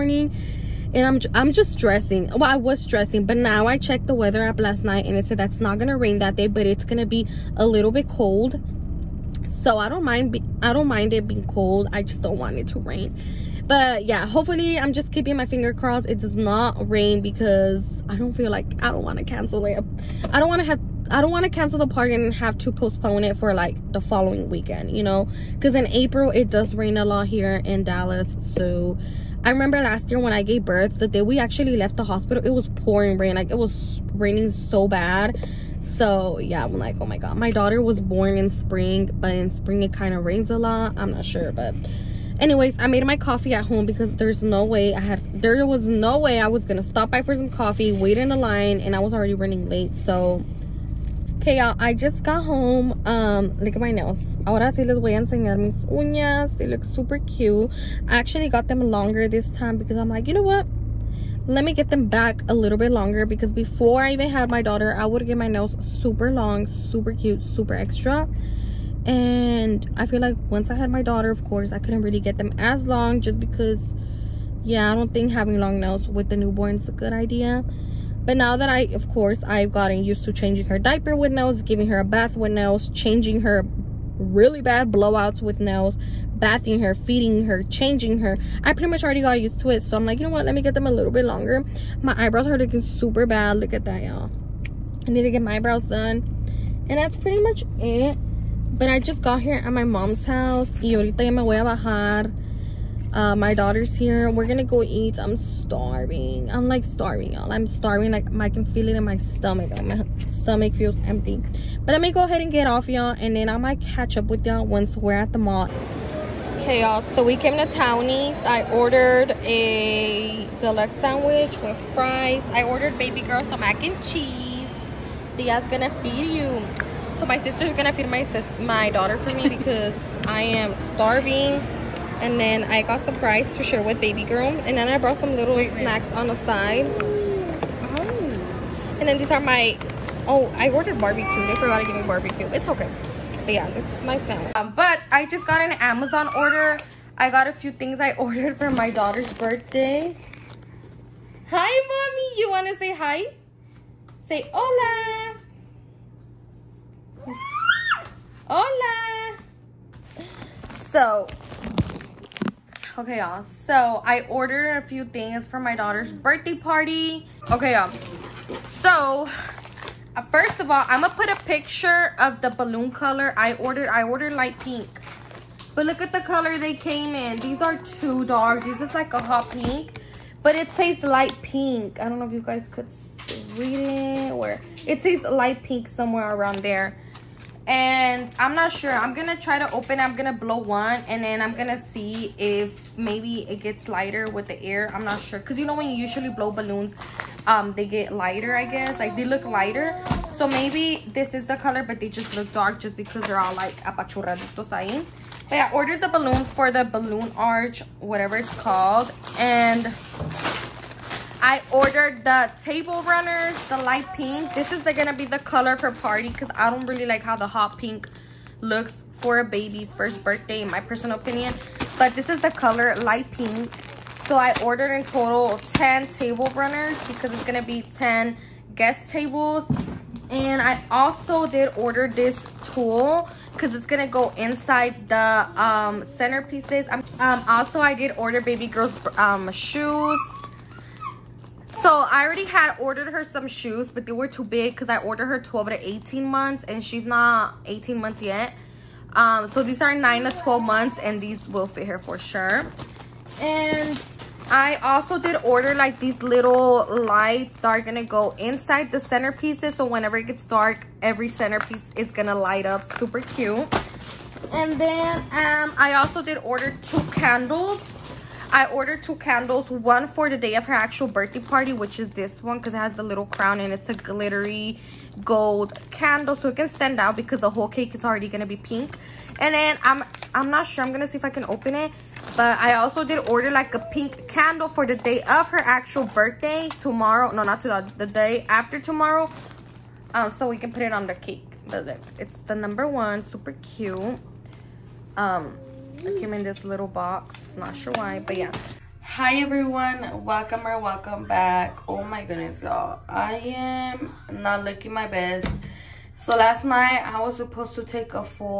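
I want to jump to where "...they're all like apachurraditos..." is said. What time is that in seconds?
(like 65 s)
203 s.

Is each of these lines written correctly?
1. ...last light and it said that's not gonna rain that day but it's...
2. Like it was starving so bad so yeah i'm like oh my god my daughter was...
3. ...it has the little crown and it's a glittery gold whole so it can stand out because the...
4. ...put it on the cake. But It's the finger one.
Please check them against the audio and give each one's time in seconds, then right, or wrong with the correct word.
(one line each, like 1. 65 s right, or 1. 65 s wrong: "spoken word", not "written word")
1. 4 s wrong: "night", not "light"
2. 33 s wrong: "raining", not "starving"
3. 272 s wrong: "candle", not "whole"
4. 290 s wrong: "number", not "finger".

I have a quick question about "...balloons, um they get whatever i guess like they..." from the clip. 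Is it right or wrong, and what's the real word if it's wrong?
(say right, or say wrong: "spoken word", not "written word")
wrong: "lighter", not "whatever".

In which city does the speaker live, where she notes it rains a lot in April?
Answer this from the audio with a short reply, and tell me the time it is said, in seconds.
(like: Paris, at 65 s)
Dallas, at 27 s.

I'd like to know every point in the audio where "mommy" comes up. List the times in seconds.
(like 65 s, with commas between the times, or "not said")
151 s.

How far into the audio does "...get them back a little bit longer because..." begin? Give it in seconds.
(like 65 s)
61 s.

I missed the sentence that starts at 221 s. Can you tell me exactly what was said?
But this is the color light pink.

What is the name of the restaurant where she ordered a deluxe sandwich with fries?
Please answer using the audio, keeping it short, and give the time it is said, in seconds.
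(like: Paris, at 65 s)
Townies, at 117 s.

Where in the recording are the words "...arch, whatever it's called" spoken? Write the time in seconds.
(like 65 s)
207 s.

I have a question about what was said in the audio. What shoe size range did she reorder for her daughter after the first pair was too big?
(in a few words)
9 to 12 months.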